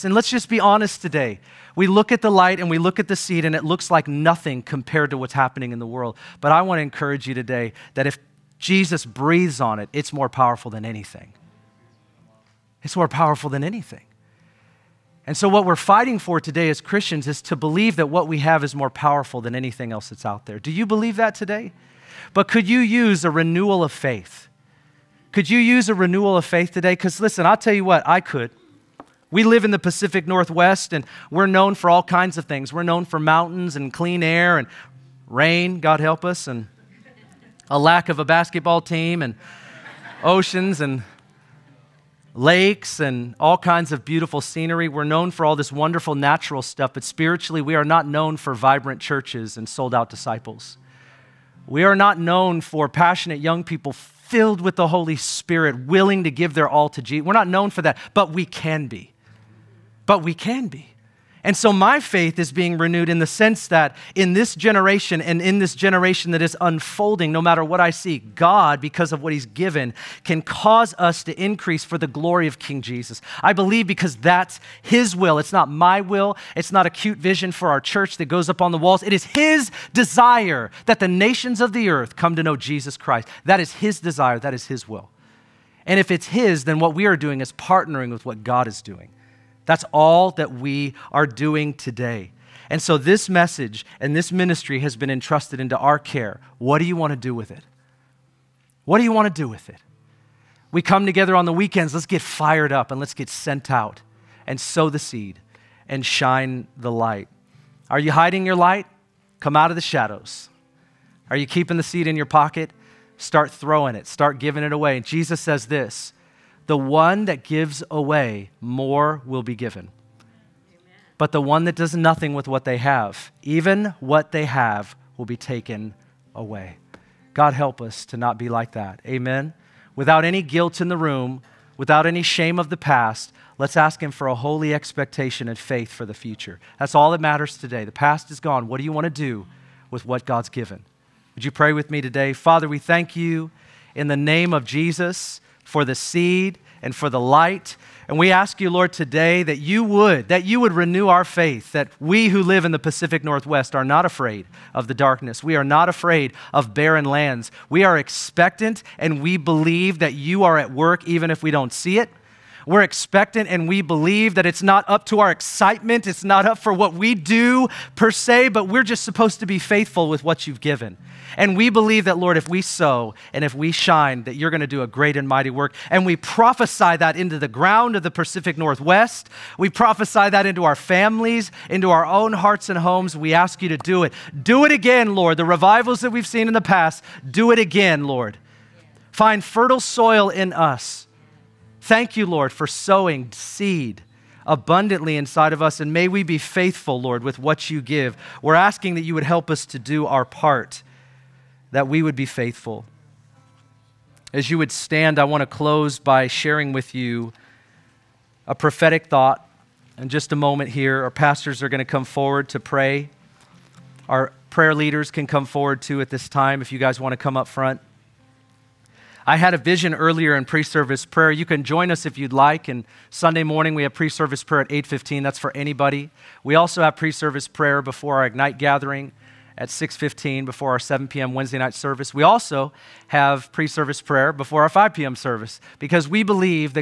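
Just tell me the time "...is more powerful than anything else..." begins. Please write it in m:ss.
0:18.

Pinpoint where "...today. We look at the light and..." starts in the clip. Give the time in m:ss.
0:00.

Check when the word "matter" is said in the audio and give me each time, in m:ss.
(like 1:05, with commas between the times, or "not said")
1:07, 2:17.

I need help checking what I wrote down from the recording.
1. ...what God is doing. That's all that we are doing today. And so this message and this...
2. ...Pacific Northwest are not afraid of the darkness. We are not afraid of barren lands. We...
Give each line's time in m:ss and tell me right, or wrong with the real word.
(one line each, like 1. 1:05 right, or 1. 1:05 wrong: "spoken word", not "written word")
1. 1:28 right
2. 2:32 right.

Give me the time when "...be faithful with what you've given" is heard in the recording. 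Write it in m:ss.
2:49.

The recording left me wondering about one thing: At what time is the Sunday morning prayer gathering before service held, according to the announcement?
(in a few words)
8:15.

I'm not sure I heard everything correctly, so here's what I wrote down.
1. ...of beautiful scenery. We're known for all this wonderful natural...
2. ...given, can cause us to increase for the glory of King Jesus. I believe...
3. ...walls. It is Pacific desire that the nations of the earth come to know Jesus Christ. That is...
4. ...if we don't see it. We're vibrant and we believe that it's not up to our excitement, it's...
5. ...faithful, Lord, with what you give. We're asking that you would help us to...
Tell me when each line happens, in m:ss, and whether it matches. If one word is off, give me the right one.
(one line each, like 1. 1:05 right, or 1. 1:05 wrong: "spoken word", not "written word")
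1. 0:43 right
2. 1:09 right
3. 1:18 wrong: "His", not "Pacific"
4. 2:41 wrong: "expectant", not "vibrant"
5. 3:16 right.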